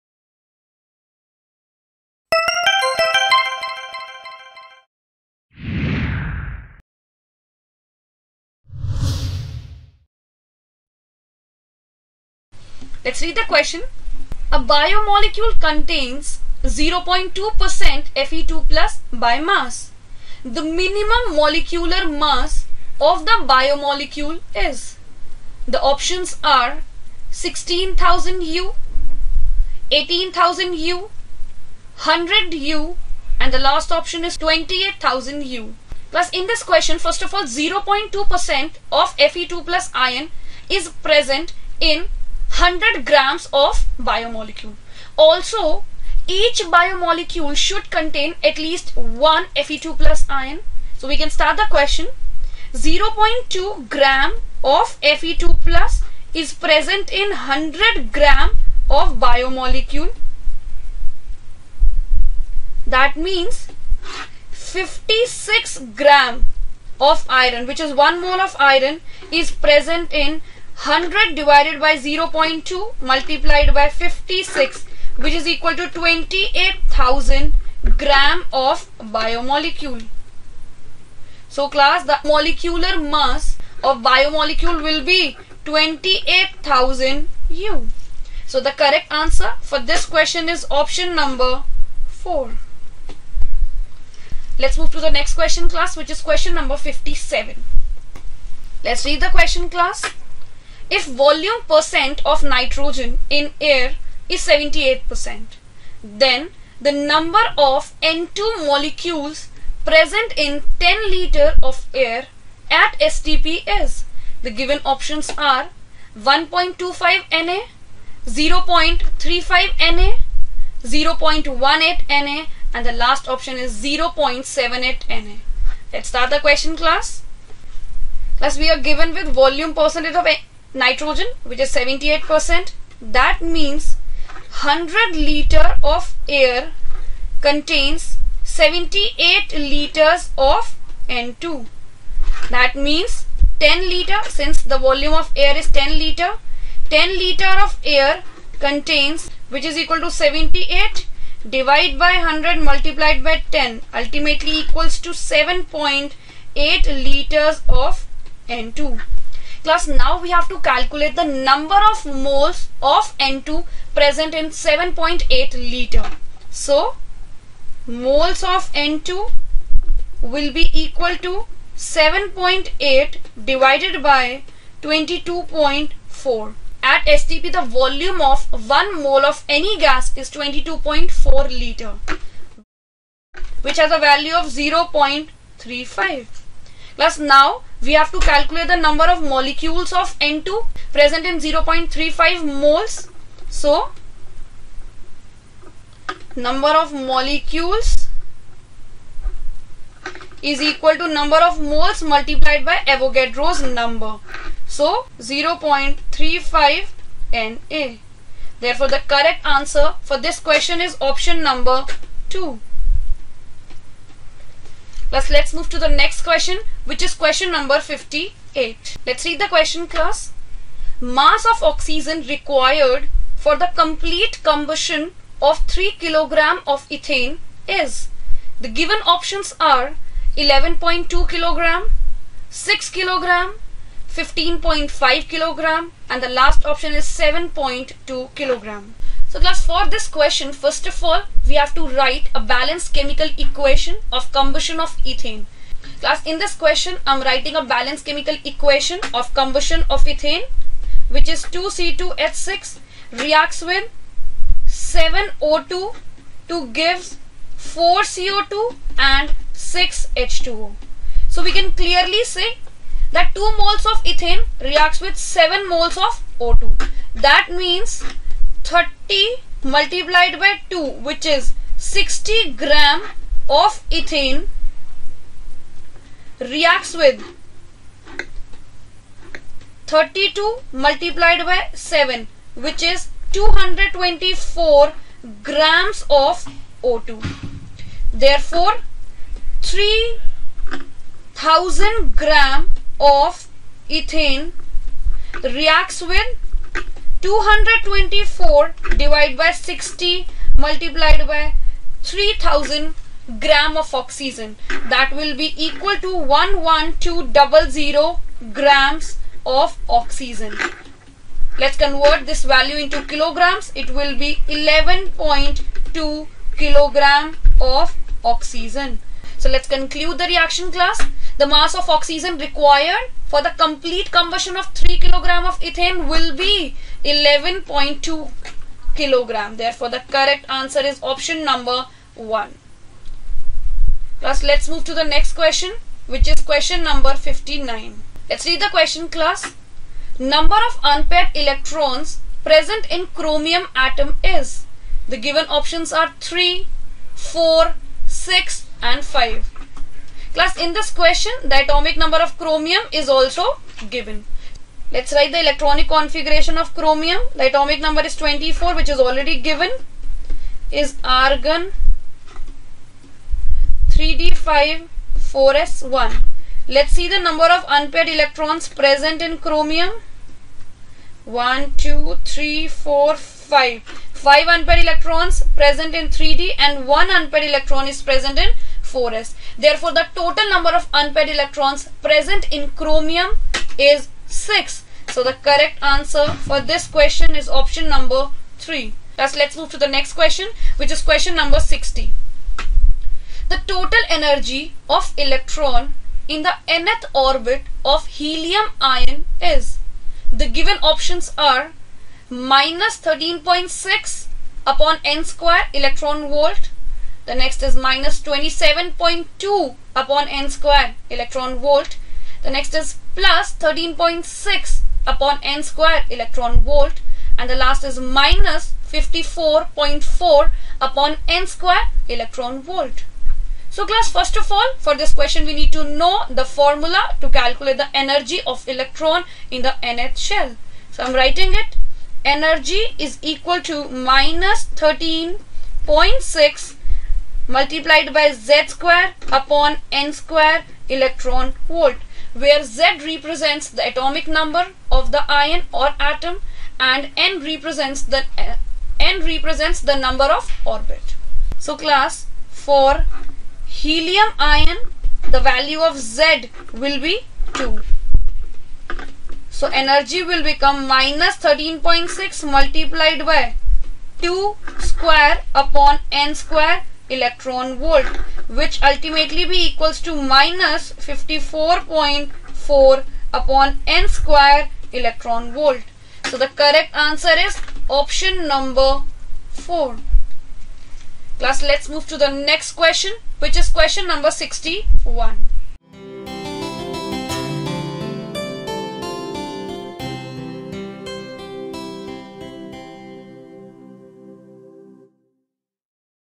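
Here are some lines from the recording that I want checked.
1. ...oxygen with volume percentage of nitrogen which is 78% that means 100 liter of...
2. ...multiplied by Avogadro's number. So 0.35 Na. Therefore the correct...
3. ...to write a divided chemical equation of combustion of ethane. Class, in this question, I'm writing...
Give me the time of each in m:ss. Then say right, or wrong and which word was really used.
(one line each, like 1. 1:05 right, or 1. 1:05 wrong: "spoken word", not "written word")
1. 2:08 wrong: "given", not "oxygen"
2. 3:22 right
3. 4:01 wrong: "balanced", not "divided".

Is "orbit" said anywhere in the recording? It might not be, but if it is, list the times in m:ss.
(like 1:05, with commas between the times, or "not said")
6:37, 7:30.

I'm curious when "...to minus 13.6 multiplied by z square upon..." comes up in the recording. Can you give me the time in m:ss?
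7:13.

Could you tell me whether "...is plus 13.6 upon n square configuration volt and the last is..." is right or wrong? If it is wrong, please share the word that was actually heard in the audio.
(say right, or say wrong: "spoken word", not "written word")
wrong: "electron", not "configuration".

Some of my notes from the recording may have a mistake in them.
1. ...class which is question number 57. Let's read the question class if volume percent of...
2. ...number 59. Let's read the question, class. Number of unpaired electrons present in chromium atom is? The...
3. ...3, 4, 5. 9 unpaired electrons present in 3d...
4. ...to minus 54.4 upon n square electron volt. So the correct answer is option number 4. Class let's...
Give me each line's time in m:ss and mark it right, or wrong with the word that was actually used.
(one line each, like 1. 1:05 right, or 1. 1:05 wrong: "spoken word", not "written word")
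1. 1:35 right
2. 5:36 right
3. 6:12 wrong: "5", not "9"
4. 7:50 right.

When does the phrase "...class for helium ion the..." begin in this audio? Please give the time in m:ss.
7:31.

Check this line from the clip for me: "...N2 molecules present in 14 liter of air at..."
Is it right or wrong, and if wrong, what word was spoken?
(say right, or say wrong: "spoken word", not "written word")
wrong: "10", not "14".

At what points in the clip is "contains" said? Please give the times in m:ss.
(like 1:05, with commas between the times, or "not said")
0:15, 0:47, 2:17, 2:28.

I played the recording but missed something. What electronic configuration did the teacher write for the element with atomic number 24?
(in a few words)
argon 3d5 4s1.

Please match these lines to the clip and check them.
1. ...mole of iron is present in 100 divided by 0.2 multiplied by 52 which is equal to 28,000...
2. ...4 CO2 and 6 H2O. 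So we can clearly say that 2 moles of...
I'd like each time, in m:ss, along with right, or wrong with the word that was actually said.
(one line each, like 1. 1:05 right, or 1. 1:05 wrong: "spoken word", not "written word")
1. 1:08 wrong: "56", not "52"
2. 4:17 right.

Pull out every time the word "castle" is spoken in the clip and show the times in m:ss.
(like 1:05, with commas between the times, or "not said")
not said.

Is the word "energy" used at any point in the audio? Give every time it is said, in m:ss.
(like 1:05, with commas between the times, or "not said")
6:34, 7:07, 7:12, 7:39.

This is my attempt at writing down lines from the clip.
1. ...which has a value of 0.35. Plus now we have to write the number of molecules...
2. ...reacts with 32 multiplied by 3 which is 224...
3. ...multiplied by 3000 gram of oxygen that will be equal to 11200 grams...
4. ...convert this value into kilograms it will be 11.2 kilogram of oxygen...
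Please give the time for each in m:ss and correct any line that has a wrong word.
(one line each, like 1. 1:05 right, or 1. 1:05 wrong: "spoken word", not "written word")
1. 3:03 wrong: "calculate", not "write"
2. 4:36 wrong: "7", not "3"
3. 5:00 right
4. 5:11 right.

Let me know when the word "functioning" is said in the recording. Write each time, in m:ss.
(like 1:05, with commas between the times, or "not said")
not said.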